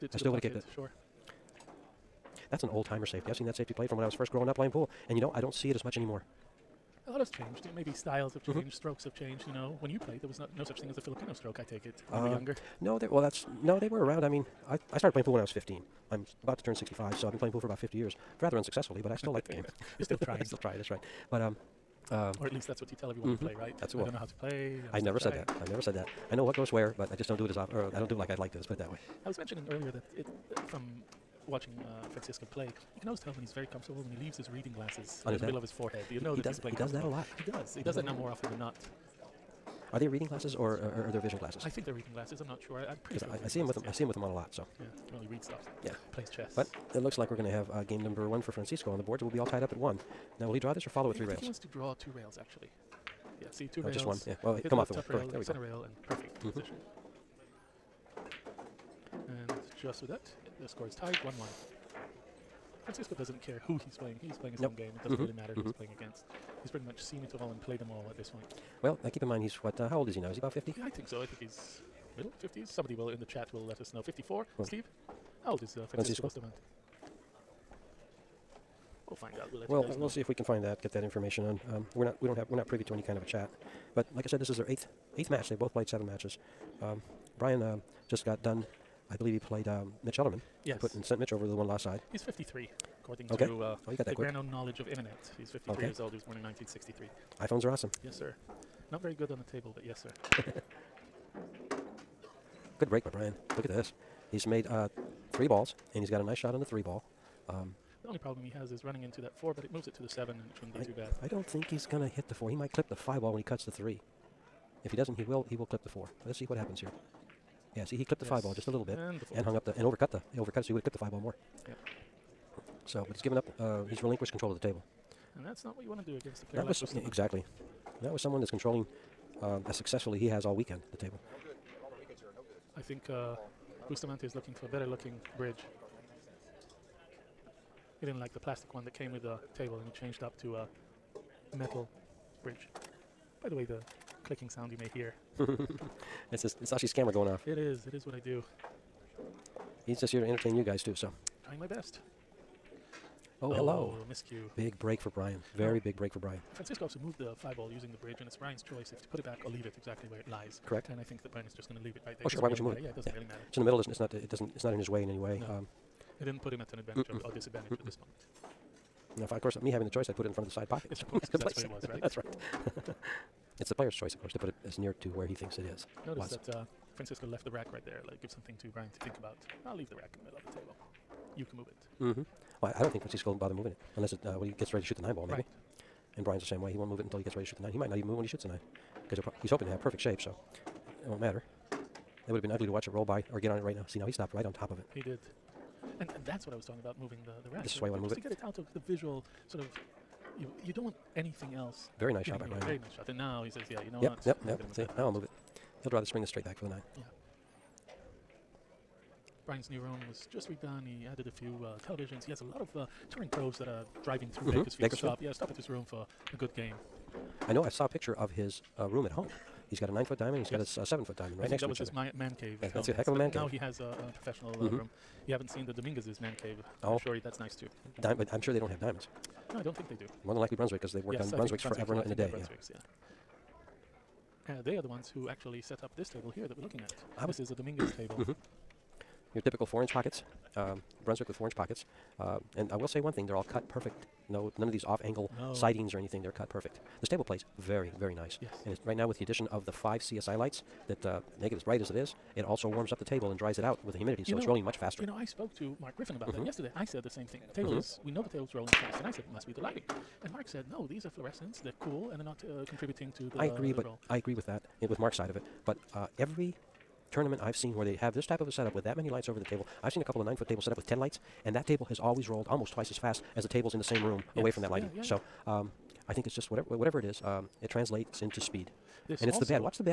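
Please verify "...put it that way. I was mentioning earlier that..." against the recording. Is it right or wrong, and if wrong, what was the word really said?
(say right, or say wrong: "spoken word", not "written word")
right.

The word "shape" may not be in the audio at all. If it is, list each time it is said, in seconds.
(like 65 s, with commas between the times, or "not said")
189 s.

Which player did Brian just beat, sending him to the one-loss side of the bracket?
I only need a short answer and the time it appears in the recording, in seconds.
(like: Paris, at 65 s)
Mitch Ellerman, at 90 s.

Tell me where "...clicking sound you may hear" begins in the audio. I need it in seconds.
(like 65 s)
144 s.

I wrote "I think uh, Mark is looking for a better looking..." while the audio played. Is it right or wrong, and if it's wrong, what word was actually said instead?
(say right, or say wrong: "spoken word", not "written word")
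wrong: "Bustamante", not "Mark".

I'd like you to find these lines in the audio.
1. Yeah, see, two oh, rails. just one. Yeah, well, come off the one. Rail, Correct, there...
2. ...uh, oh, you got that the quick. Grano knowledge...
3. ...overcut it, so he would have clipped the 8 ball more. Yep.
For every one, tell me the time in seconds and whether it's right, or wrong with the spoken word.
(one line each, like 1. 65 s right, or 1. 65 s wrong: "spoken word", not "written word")
1. 53 s right
2. 93 s right
3. 120 s wrong: "5", not "8".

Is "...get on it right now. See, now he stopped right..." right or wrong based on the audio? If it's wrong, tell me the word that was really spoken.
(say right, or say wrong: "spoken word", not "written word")
right.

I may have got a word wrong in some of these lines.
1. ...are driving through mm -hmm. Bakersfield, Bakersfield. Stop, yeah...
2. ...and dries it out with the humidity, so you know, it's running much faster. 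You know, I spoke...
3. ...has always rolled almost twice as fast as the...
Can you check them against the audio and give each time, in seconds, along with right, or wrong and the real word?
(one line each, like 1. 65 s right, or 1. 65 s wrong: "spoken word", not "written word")
1. 213 s right
2. 253 s wrong: "rolling", not "running"
3. 271 s right.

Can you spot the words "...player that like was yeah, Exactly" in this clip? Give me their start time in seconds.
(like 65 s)
126 s.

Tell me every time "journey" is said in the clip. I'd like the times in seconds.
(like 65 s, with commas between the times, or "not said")
not said.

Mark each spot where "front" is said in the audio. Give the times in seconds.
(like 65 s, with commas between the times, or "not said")
170 s.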